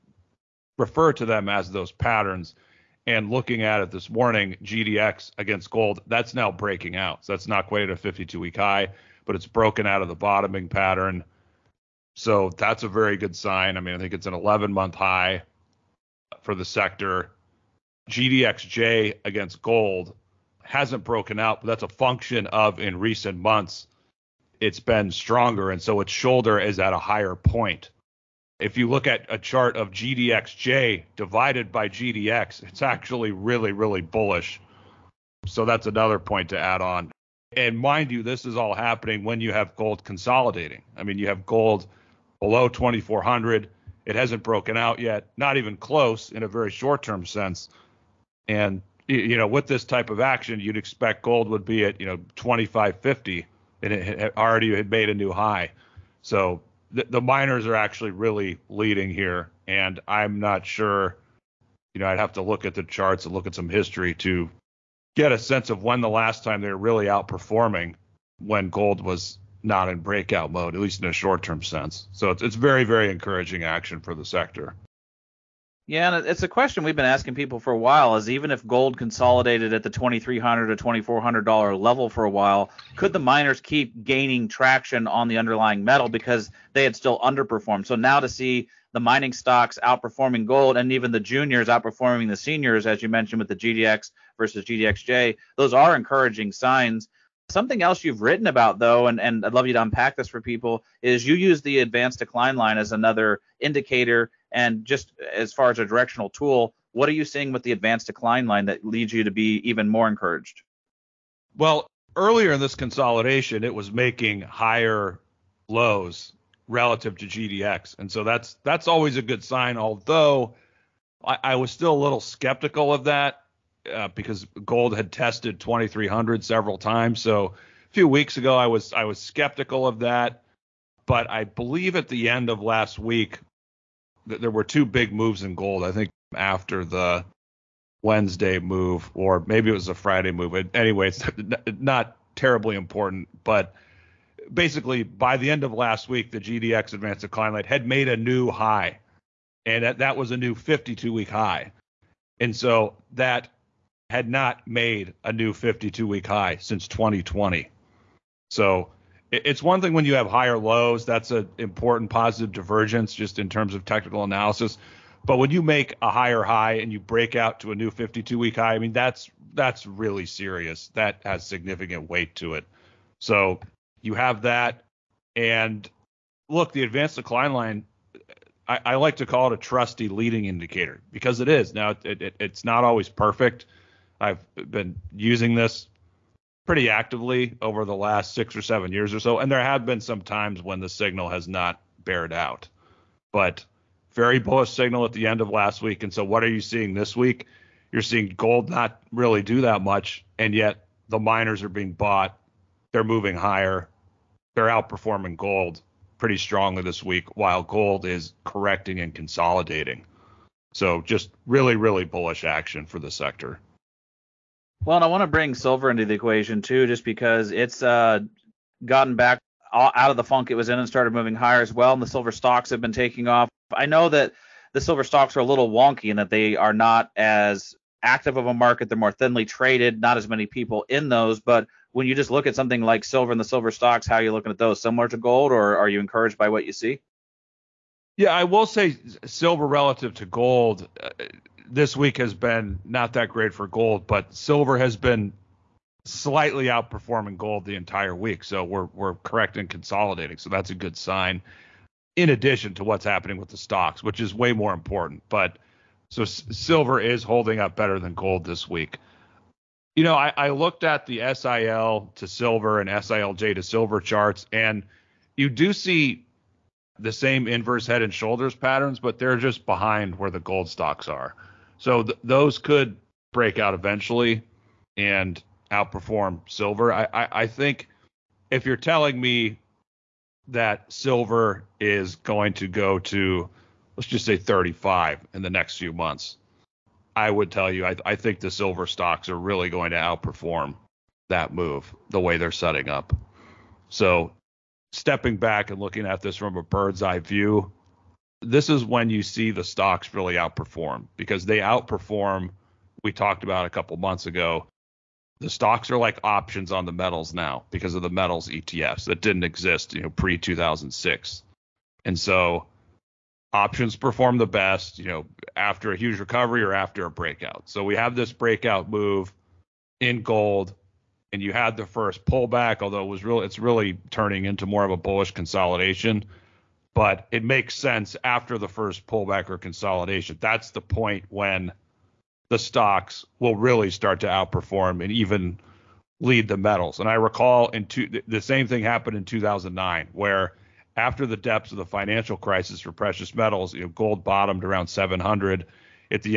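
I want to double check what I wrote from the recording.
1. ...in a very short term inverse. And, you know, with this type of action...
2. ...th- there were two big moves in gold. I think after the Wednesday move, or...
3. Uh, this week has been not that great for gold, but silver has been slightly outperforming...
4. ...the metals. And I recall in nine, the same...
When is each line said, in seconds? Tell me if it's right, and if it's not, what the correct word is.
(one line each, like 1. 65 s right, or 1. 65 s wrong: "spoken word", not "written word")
1. 46 s wrong: "sense", not "inverse"
2. 134 s right
3. 240 s right
4. 336 s wrong: "two", not "nine".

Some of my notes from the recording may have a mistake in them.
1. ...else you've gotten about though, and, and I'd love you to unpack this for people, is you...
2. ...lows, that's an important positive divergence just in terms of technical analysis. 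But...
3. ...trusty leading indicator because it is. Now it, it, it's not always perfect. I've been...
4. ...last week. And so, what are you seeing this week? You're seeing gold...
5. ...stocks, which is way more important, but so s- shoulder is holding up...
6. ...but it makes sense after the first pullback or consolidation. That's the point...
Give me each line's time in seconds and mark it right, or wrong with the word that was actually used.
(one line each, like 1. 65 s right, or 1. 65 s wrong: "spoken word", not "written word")
1. 97 s wrong: "written", not "gotten"
2. 160 s right
3. 179 s right
4. 195 s right
5. 253 s wrong: "silver", not "shoulder"
6. 326 s right.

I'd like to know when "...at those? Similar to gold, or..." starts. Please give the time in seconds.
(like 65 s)
234 s.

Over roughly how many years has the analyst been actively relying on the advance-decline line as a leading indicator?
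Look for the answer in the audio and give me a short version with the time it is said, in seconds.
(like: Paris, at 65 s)
six or seven years, at 188 s.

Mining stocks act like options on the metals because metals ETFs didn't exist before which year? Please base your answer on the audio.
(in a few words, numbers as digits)
2006.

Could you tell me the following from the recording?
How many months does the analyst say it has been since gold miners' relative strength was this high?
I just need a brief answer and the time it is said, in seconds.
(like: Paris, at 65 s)
11 months, at 14 s.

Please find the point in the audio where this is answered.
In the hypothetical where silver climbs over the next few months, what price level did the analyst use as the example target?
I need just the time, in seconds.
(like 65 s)
284 s.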